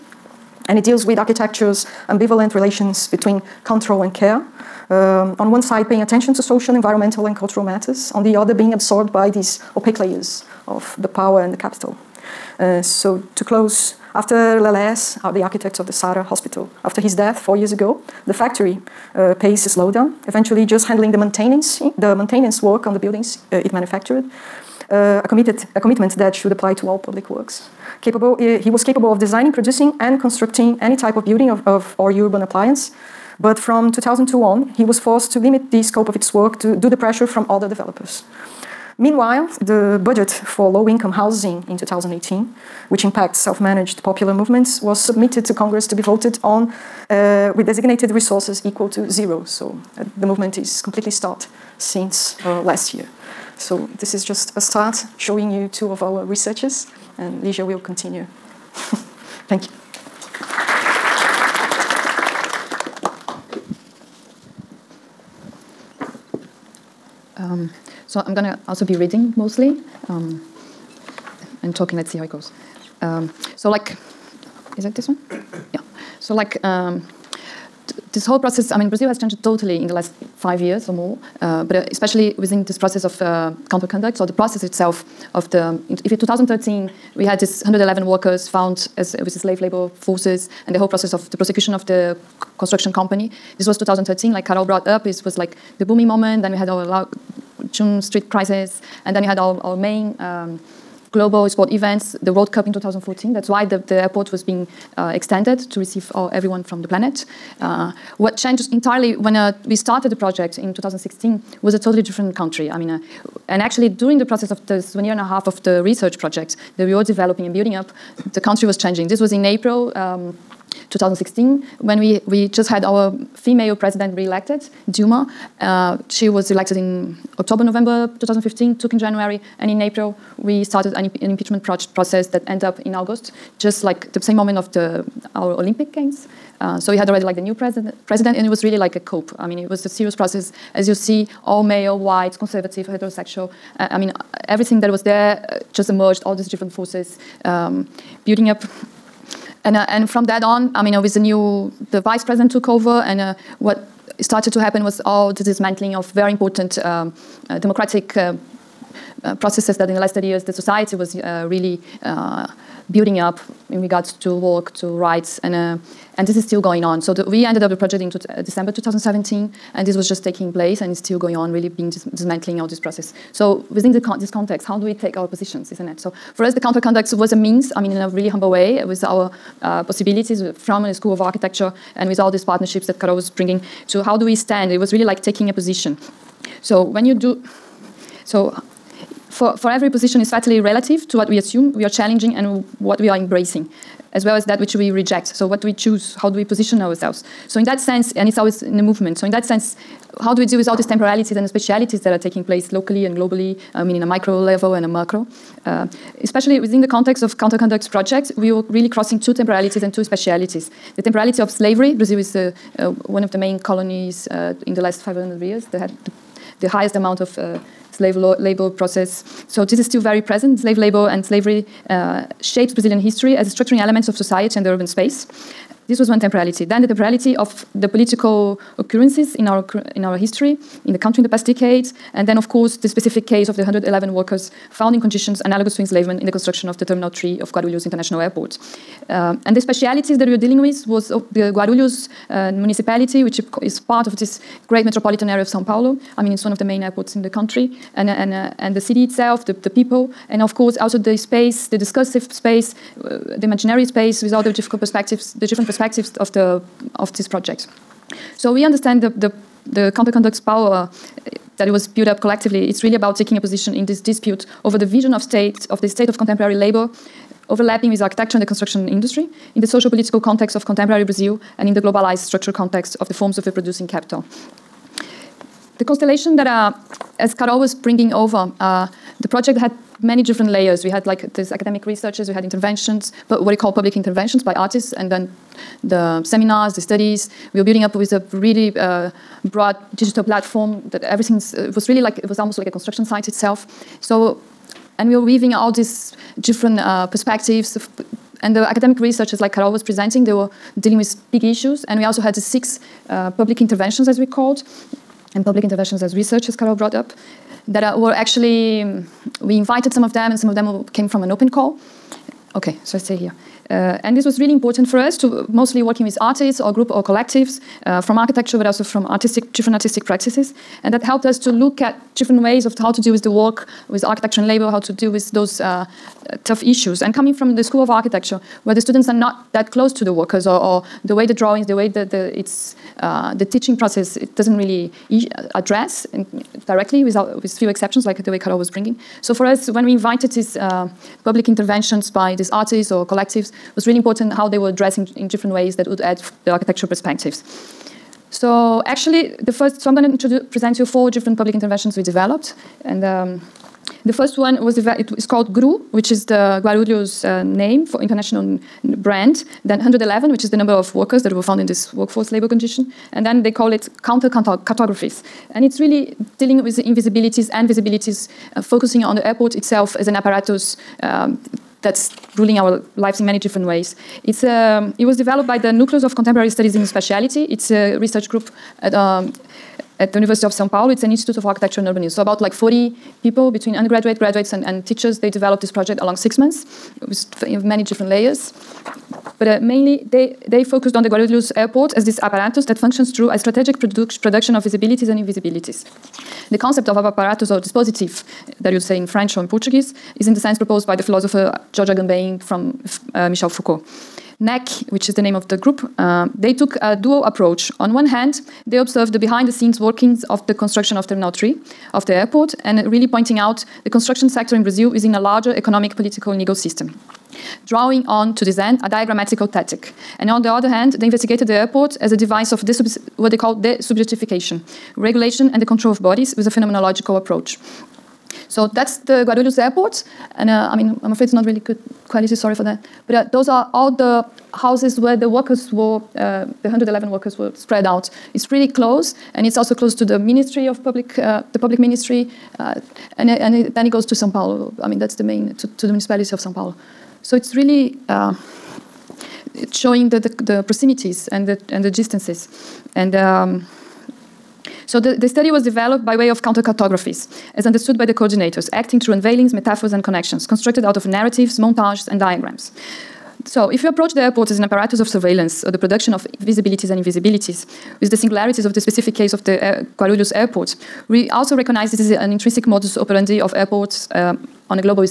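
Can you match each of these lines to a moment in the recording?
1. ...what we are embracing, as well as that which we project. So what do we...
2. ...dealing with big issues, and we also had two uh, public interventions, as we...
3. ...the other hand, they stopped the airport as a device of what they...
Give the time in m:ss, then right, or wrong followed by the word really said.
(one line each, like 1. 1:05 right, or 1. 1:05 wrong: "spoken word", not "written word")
1. 3:12 wrong: "reject", not "project"
2. 5:00 wrong: "six", not "two"
3. 7:00 wrong: "investigated", not "stopped".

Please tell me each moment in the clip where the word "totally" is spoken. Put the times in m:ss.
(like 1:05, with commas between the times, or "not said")
1:19, 1:51.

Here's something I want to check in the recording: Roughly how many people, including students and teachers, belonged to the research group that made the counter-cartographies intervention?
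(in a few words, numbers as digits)
about 40.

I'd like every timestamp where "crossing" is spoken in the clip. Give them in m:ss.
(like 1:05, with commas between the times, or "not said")
3:28.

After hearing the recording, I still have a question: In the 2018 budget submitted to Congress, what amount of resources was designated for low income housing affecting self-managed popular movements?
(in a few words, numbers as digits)
zero.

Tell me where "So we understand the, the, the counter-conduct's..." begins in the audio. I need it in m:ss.
4:18.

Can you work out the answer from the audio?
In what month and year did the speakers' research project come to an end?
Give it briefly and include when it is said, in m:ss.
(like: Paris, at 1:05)
December 2017, at 2:48.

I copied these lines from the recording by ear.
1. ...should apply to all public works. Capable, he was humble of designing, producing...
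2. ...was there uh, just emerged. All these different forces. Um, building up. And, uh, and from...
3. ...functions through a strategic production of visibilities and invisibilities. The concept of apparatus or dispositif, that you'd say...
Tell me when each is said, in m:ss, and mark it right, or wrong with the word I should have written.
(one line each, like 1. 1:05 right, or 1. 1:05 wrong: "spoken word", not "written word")
1. 0:26 wrong: "capable", not "humble"
2. 2:24 right
3. 6:32 right.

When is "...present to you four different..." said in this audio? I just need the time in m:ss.
5:50.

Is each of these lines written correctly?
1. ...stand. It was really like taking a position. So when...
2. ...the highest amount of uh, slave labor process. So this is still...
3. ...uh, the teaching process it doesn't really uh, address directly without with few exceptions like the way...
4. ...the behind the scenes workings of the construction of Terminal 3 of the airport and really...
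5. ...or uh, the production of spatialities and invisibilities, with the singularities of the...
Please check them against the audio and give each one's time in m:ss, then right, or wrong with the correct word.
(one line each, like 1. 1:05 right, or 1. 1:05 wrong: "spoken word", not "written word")
1. 3:04 right
2. 3:36 right
3. 5:33 right
4. 6:49 right
5. 7:45 wrong: "visibilities", not "spatialities".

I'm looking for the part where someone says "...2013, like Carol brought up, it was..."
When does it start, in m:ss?
1:33.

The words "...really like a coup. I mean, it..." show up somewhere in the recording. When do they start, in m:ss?
2:18.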